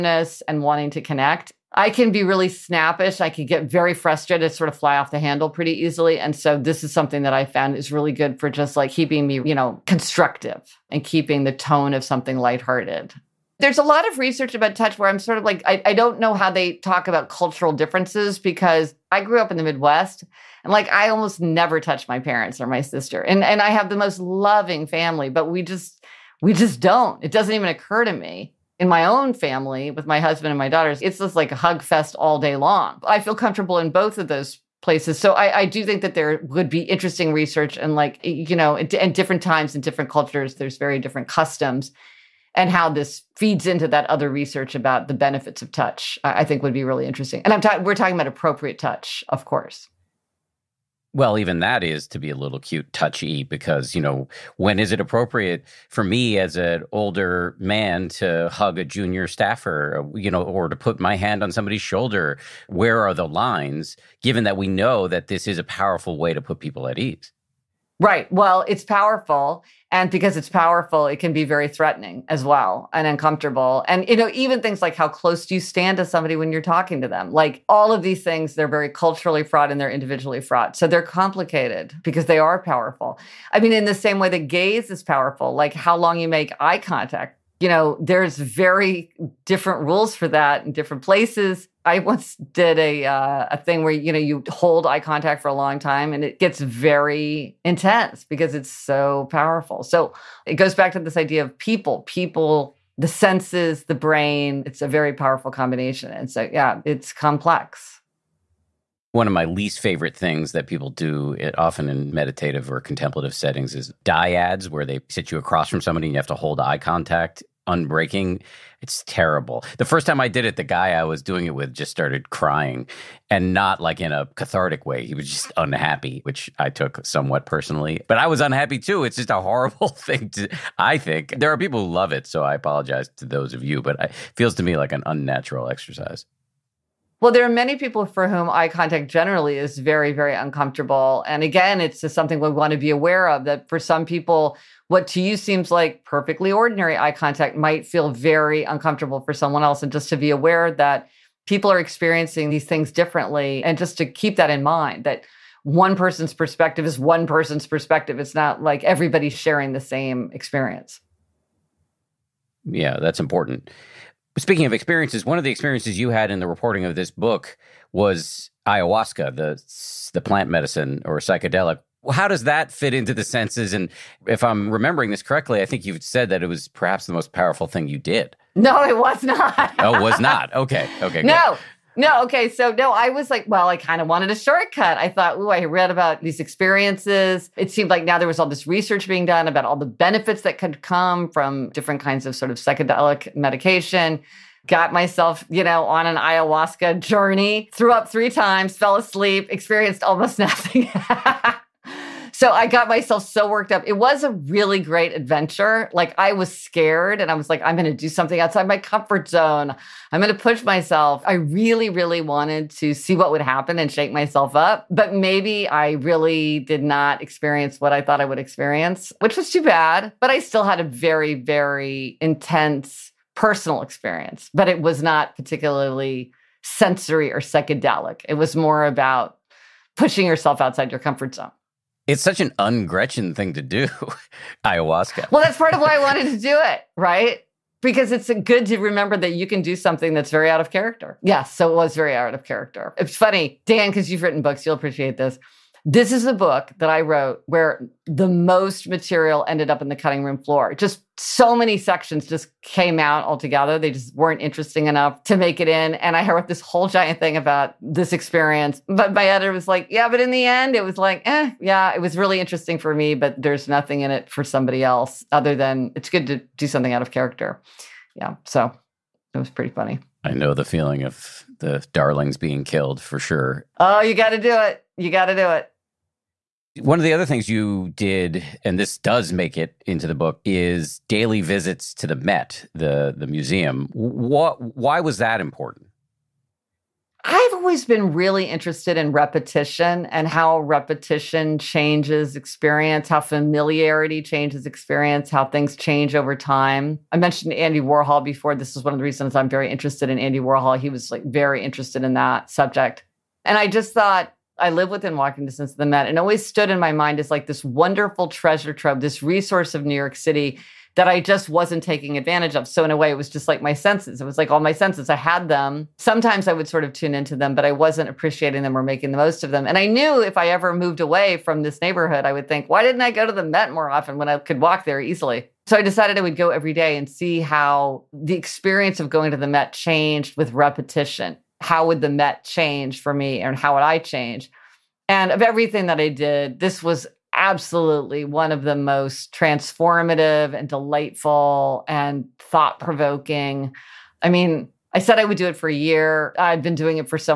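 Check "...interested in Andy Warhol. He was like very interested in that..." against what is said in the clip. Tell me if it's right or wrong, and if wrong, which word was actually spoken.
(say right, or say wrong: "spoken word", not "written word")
right.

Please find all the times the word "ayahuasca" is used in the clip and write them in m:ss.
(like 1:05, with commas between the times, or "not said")
2:48, 3:16, 3:54.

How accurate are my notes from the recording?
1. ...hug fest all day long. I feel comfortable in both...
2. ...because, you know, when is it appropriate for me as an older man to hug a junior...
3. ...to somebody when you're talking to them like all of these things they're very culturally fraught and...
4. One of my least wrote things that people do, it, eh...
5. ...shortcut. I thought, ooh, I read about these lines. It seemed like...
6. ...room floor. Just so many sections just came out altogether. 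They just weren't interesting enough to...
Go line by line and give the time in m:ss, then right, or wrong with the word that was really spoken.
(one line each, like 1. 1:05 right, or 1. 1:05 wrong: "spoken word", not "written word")
1. 0:31 right
2. 0:53 right
3. 1:15 right
4. 1:49 wrong: "favorite", not "wrote"
5. 3:04 wrong: "experiences", not "lines"
6. 4:10 right.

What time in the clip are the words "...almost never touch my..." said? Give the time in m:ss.
0:21.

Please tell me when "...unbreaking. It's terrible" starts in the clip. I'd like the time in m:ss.
1:57.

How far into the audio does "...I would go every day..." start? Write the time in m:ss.
5:26.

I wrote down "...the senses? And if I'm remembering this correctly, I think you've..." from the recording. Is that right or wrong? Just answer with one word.
right.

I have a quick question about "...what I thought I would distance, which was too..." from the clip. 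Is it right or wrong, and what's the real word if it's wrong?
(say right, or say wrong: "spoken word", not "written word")
wrong: "experience", not "distance".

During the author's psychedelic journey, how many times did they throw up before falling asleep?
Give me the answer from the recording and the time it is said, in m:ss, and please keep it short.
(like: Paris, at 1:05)
3, at 3:18.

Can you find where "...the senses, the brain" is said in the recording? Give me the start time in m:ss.
1:42.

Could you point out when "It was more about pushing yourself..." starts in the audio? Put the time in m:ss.
3:48.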